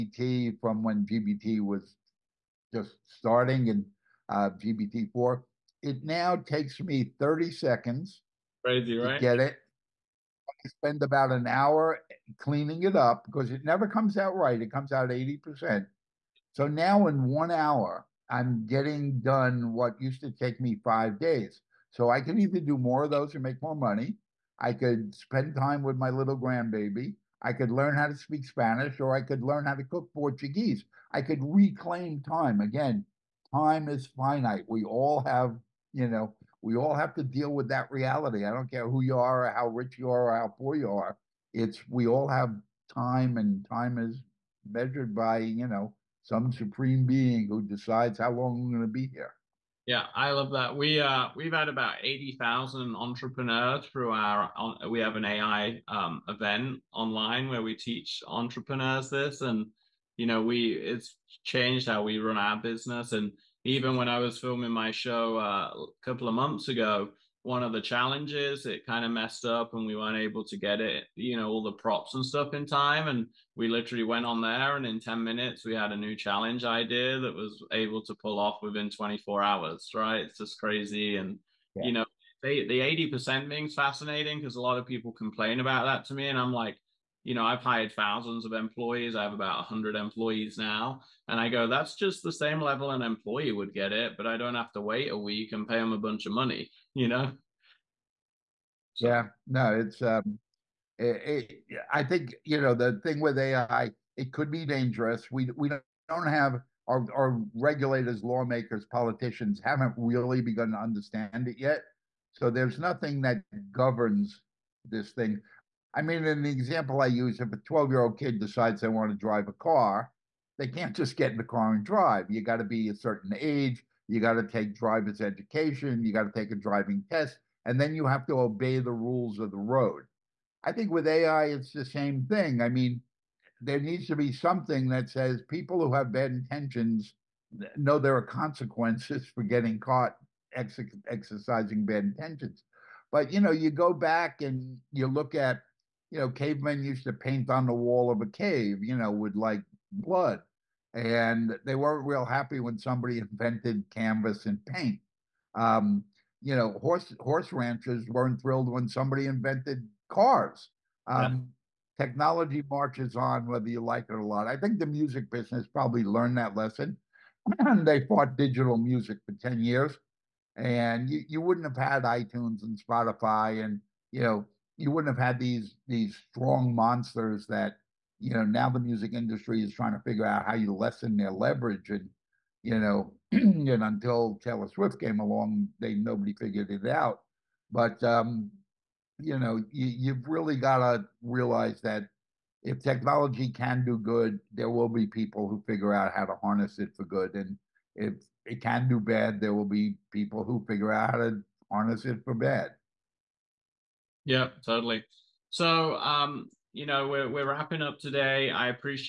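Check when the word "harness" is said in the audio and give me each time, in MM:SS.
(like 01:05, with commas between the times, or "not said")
03:16, 03:21.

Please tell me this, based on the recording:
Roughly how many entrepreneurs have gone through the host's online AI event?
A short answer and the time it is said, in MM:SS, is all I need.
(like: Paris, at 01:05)
80,000, at 00:52.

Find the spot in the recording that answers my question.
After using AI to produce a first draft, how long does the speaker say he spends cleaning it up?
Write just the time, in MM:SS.
00:11.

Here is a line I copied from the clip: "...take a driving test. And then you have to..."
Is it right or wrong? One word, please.
right.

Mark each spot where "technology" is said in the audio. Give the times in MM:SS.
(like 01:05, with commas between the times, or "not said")
02:42, 03:12.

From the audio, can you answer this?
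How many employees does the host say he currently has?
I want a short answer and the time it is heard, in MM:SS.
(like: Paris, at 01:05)
about 100, at 01:29.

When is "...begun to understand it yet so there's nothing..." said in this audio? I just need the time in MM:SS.
01:50.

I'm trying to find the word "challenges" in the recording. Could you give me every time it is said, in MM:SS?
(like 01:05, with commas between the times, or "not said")
01:07, 01:16.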